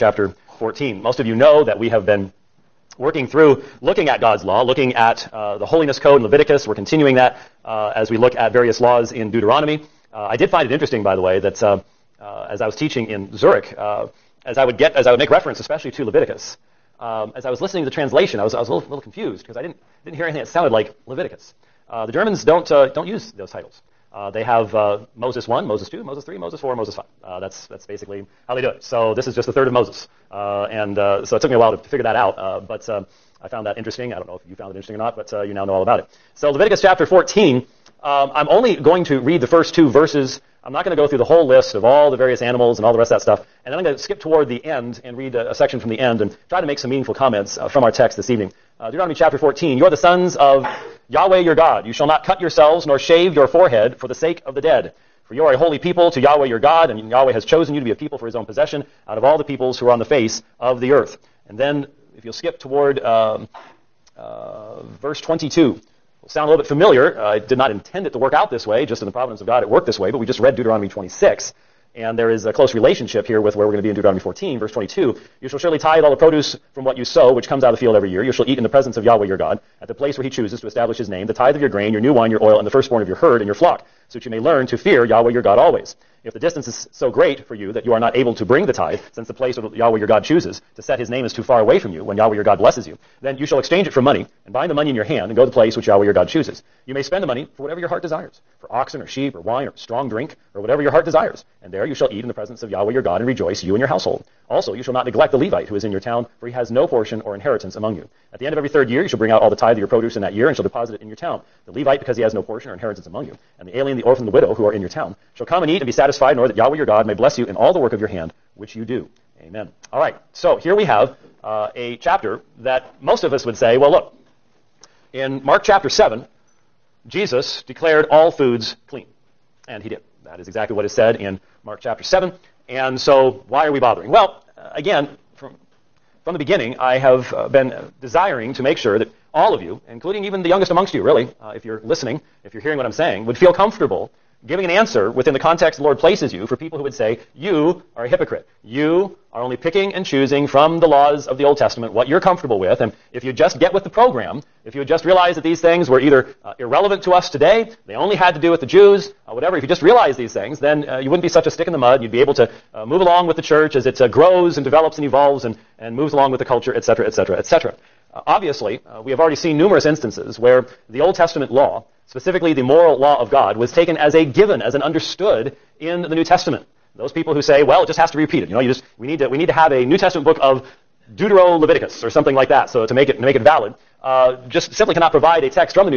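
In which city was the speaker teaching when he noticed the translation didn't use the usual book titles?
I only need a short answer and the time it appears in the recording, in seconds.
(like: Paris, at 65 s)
Zurich, at 13 s.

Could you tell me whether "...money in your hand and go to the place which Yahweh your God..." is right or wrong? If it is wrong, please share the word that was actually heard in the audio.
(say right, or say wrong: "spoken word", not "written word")
right.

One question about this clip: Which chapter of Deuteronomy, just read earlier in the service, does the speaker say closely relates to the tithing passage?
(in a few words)
26.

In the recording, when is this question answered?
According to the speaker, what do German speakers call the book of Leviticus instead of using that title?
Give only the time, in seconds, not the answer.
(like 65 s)
29 s.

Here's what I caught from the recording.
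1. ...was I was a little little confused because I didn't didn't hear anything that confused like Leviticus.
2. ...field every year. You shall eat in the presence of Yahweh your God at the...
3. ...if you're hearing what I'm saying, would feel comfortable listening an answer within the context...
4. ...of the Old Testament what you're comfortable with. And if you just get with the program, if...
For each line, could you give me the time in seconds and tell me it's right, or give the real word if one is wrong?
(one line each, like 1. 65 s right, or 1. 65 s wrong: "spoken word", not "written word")
1. 18 s wrong: "sounded", not "confused"
2. 77 s right
3. 142 s wrong: "giving", not "listening"
4. 151 s right.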